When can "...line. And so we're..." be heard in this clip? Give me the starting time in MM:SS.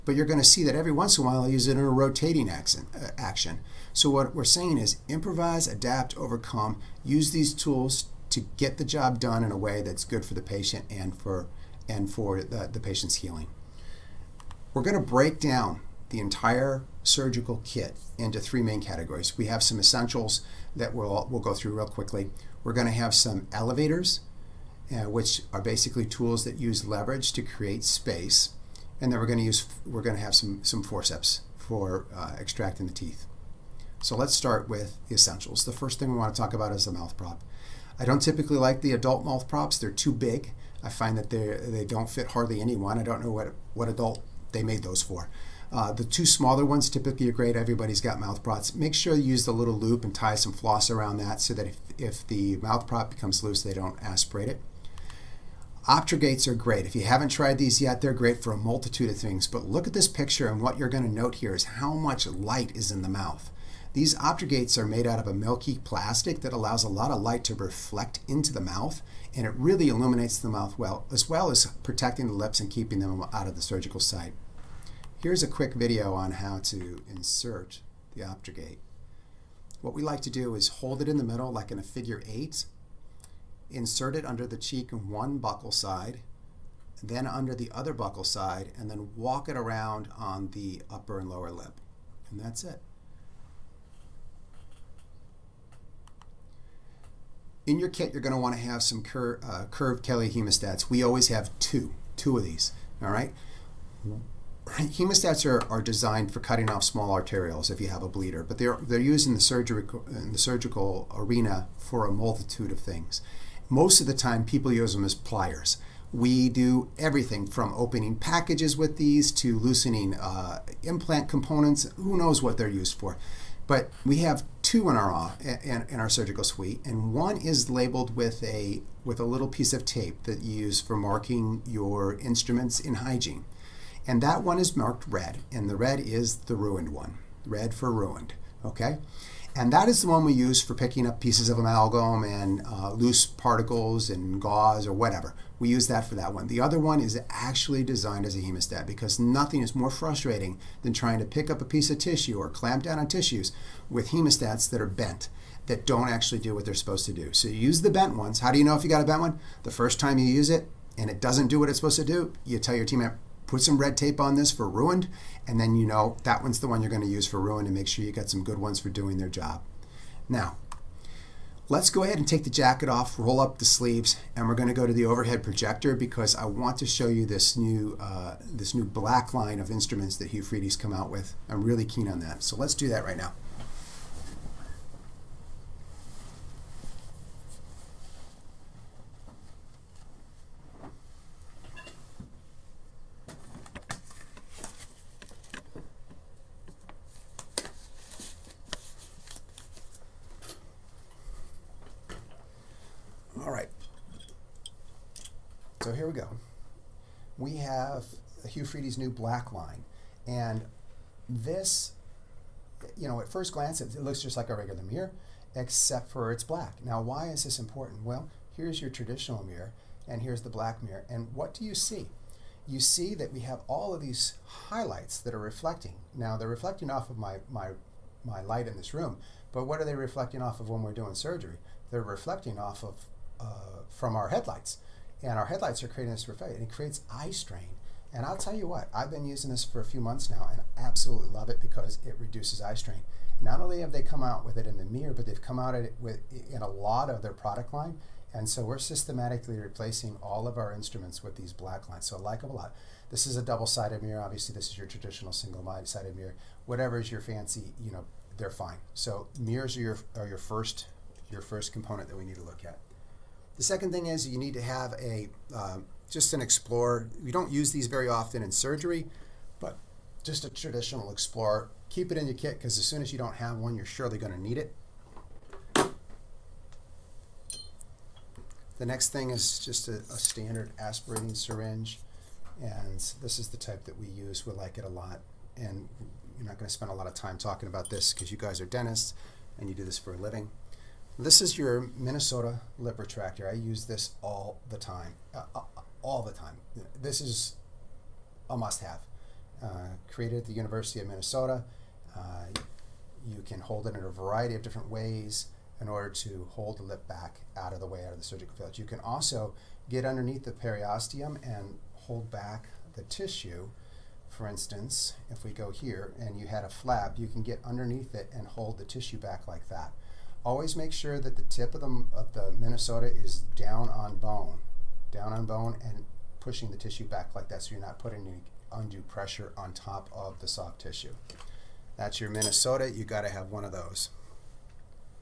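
04:07.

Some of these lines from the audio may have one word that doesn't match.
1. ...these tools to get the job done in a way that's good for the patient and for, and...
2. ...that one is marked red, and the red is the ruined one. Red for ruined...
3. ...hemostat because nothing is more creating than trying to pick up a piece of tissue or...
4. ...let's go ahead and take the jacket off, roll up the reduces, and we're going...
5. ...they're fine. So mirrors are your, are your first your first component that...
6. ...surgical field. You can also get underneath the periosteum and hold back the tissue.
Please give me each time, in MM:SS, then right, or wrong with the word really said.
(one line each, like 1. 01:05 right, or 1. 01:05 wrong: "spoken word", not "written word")
1. 00:07 right
2. 02:14 right
3. 02:28 wrong: "frustrating", not "creating"
4. 02:51 wrong: "sleeves", not "reduces"
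5. 04:18 right
6. 05:08 right.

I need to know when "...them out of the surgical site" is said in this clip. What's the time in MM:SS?
01:13.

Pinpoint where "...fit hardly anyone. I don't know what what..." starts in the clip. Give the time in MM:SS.
00:42.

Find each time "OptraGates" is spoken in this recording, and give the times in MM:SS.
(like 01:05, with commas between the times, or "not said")
00:55, 01:04, 01:18.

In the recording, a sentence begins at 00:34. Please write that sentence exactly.
So let's start with the essentials.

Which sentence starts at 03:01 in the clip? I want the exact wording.
I'm really keen on that, so let's do that right now.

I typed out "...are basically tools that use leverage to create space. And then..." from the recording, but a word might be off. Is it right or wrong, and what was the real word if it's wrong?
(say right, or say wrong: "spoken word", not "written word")
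right.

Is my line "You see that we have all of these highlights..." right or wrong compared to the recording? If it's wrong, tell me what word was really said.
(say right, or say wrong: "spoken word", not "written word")
right.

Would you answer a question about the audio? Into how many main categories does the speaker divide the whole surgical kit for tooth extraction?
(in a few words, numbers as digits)
3.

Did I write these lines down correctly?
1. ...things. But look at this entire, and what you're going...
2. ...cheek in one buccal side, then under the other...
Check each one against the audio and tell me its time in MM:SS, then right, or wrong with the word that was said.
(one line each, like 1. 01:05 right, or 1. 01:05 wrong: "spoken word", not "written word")
1. 00:59 wrong: "picture", not "entire"
2. 01:24 right.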